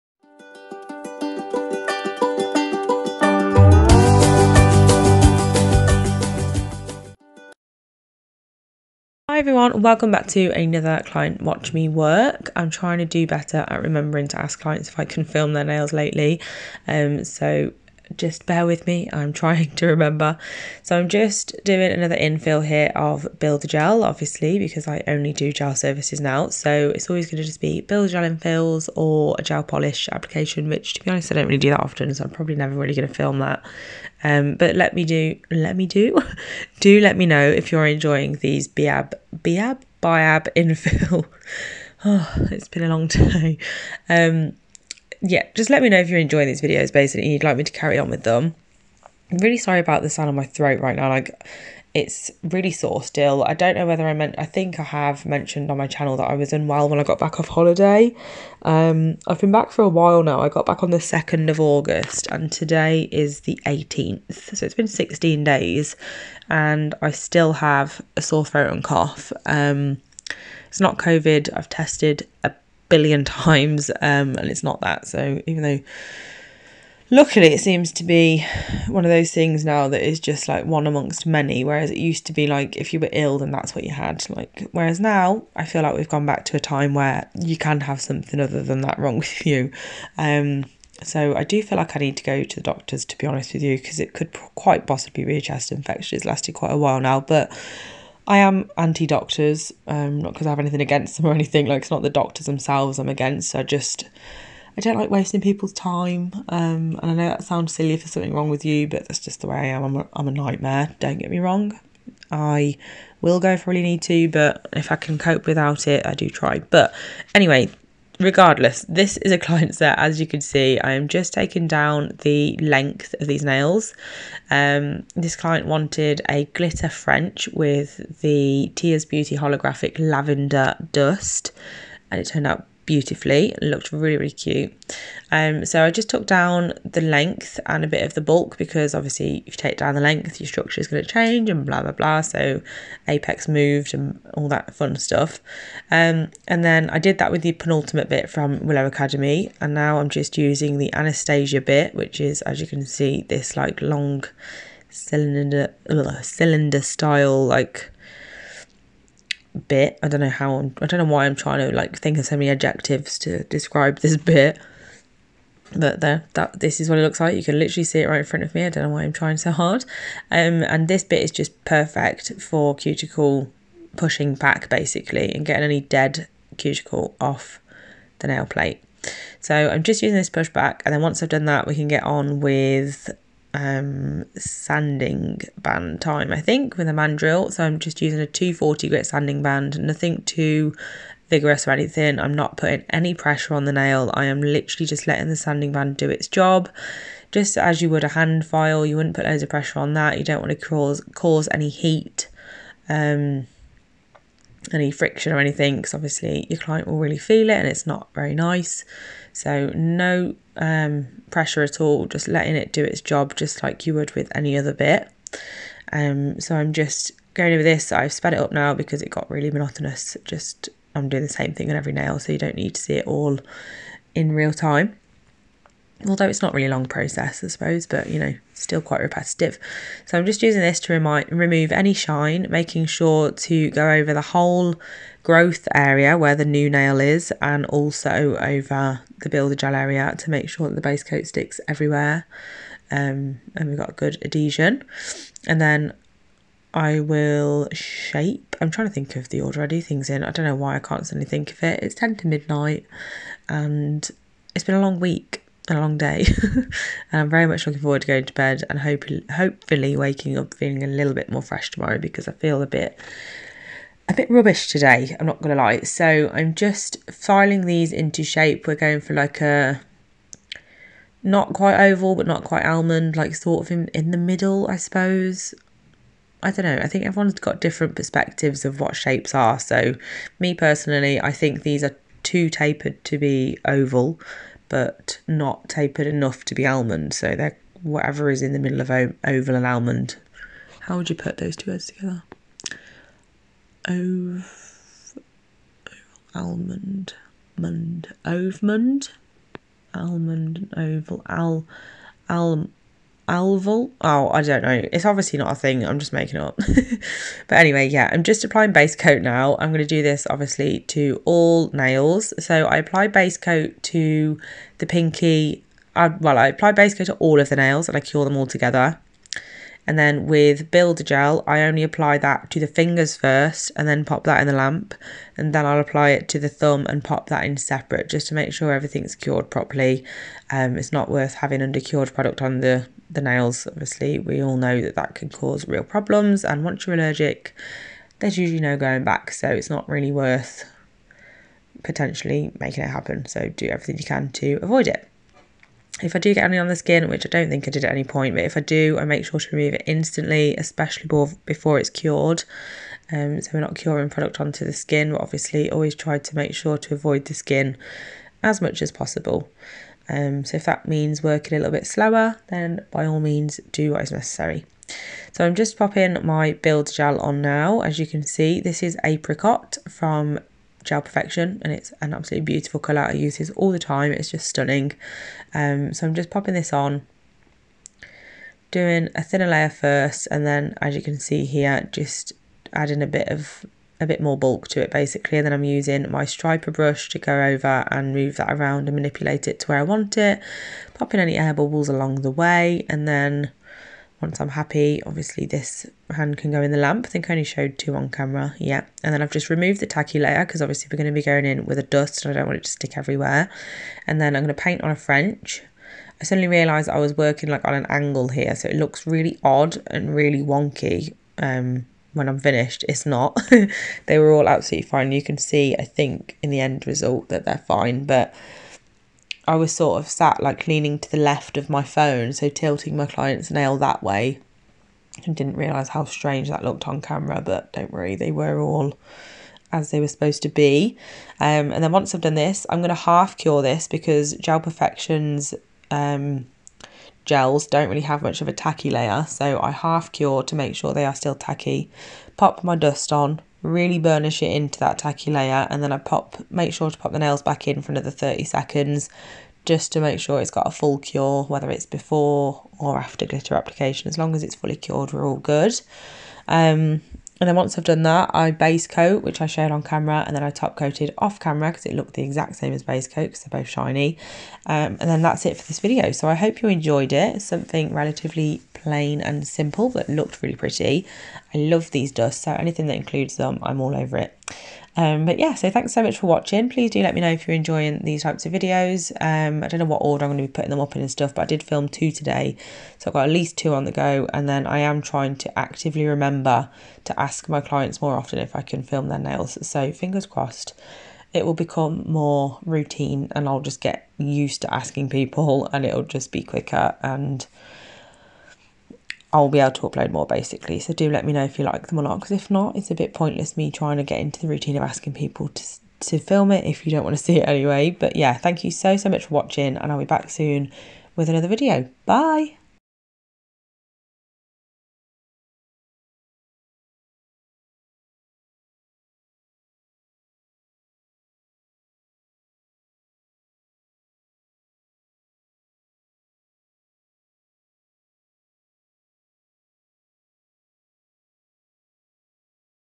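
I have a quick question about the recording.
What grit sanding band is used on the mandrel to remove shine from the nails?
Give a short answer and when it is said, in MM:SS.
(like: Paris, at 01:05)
240, at 03:08.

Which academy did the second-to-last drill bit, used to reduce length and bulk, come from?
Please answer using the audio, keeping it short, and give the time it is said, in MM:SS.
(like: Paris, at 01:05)
Willow Academy, at 02:28.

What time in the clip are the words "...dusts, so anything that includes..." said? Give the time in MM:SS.
07:52.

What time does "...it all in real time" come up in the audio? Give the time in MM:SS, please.
03:42.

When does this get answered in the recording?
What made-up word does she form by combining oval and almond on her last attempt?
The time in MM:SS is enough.
05:03.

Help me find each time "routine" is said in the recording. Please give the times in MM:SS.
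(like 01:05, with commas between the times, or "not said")
08:12, 08:24.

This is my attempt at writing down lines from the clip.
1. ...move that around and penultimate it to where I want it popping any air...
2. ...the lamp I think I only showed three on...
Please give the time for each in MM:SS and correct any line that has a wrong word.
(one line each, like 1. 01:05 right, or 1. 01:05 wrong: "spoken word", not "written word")
1. 06:28 wrong: "manipulate", not "penultimate"
2. 06:36 wrong: "two", not "three".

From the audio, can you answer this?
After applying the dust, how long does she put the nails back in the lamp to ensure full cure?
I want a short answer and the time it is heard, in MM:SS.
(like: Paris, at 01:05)
30 seconds, at 07:28.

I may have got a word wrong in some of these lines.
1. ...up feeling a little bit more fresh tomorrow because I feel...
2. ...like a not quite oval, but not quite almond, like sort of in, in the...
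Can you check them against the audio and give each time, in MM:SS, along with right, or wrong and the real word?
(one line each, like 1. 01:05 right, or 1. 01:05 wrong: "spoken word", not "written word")
1. 04:20 right
2. 04:29 right.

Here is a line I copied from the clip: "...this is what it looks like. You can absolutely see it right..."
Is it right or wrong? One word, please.
wrong.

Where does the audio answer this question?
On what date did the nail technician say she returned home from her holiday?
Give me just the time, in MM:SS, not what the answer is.
01:00.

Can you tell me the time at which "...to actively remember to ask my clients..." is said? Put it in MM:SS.
08:05.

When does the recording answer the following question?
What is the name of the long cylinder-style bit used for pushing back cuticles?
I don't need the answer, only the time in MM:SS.
02:30.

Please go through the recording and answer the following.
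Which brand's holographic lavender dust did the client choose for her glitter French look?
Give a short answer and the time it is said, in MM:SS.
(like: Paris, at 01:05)
Tia's Beauty, at 02:08.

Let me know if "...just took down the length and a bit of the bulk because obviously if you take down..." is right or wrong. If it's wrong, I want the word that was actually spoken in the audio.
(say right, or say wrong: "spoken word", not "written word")
right.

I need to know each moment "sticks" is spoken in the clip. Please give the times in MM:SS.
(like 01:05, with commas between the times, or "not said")
04:01, 06:42.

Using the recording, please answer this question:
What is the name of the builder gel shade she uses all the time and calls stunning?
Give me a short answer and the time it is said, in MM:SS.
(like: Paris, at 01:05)
Apricot, at 06:09.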